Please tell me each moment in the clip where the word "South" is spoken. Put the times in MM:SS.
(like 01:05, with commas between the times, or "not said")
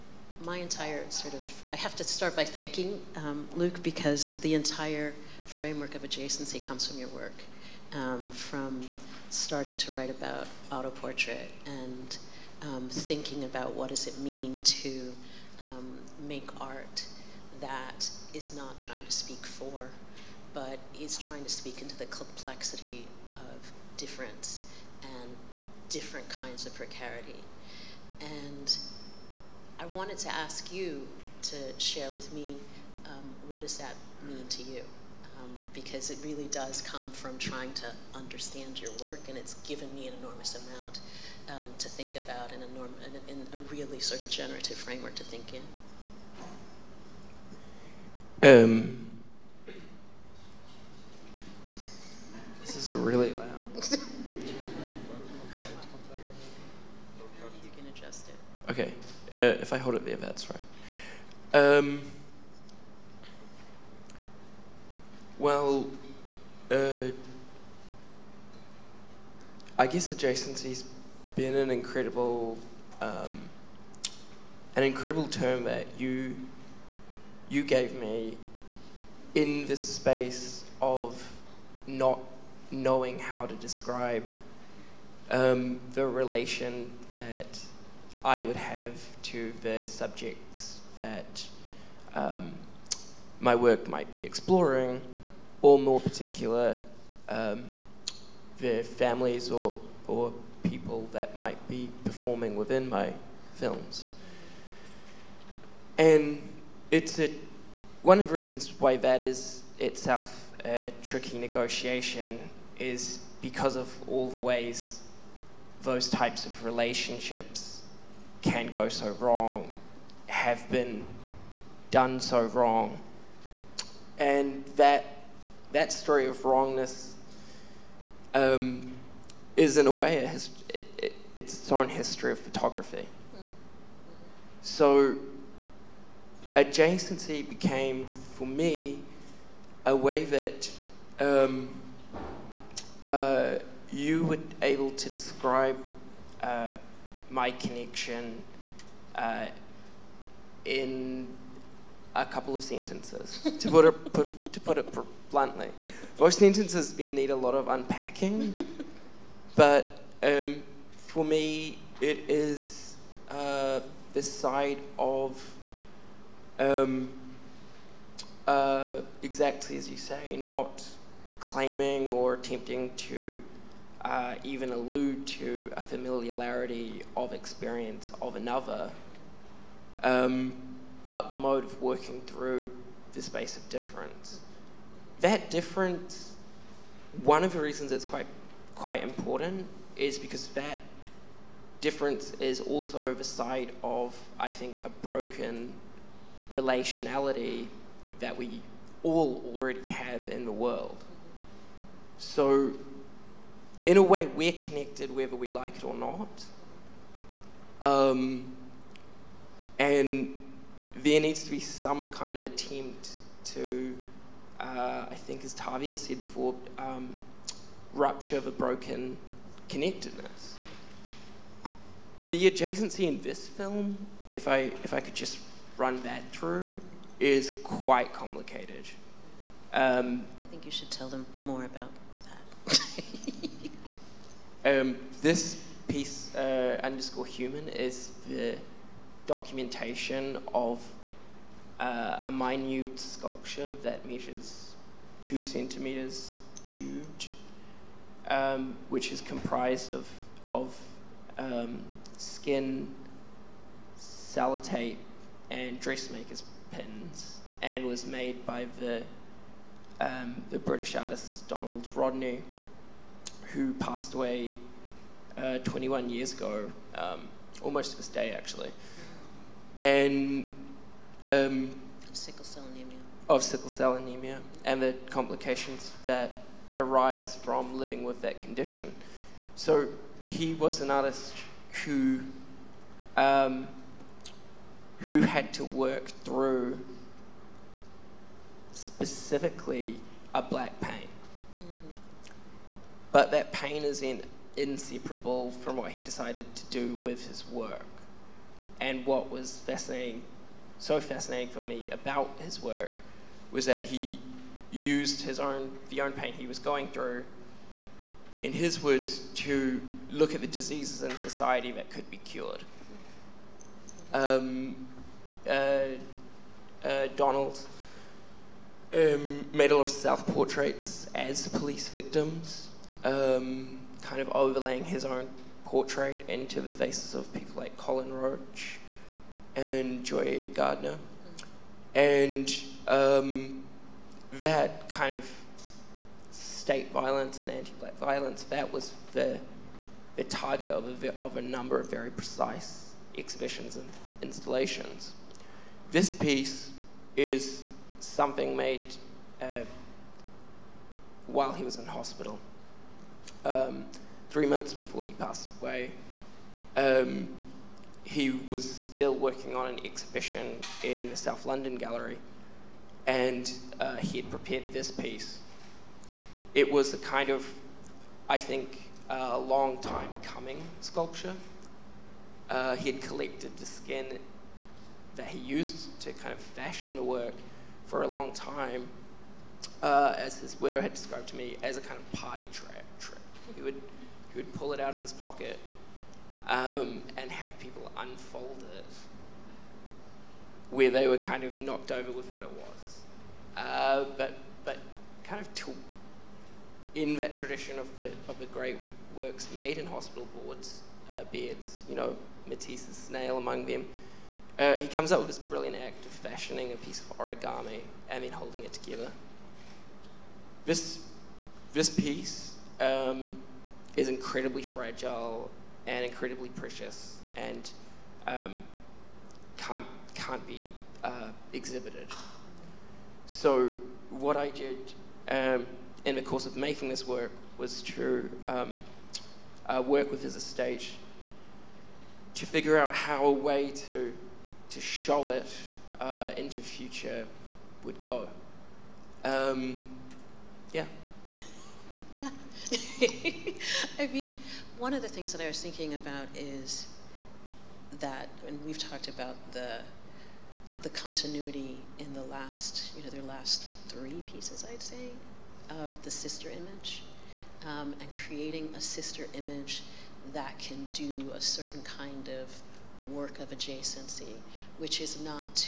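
06:01.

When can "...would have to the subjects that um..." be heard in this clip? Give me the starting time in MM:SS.
01:28.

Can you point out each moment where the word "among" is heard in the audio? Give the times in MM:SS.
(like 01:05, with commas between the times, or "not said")
06:43.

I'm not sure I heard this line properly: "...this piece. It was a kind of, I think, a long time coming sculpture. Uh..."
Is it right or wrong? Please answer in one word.
right.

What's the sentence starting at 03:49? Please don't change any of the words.
Um, I think you should tell them more about that.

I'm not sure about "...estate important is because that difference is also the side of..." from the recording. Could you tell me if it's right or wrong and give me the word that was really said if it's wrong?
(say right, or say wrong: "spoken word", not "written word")
wrong: "quite", not "estate".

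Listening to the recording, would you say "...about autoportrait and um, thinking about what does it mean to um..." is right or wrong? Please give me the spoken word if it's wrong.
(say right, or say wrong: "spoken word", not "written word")
right.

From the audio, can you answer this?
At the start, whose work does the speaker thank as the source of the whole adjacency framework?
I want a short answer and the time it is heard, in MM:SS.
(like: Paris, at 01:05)
Luke, at 00:03.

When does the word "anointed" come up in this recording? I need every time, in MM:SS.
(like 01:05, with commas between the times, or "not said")
not said.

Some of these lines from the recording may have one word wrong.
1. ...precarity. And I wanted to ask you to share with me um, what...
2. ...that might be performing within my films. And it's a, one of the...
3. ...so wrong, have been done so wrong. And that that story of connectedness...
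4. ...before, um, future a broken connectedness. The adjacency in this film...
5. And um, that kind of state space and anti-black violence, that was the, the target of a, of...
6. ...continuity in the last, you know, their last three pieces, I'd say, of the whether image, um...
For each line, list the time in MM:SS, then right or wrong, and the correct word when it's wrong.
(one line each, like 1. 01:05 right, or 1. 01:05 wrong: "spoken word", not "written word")
1. 00:26 right
2. 01:41 right
3. 01:58 wrong: "wrongness", not "connectedness"
4. 03:36 wrong: "rupture", not "future"
5. 05:31 wrong: "violence", not "space"
6. 07:30 wrong: "sister", not "whether".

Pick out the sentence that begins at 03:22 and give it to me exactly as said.
So, in a way, we're connected whether we like it or not.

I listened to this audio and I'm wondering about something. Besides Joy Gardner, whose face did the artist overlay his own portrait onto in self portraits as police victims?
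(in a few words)
Colin Roach.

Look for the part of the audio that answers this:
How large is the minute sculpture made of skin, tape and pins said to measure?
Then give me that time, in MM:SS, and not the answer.
04:05.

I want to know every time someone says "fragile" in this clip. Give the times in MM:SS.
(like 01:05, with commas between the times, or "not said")
06:54.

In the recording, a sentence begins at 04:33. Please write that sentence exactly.
Of sickle cell anemia and the complications that arise from living with that condition.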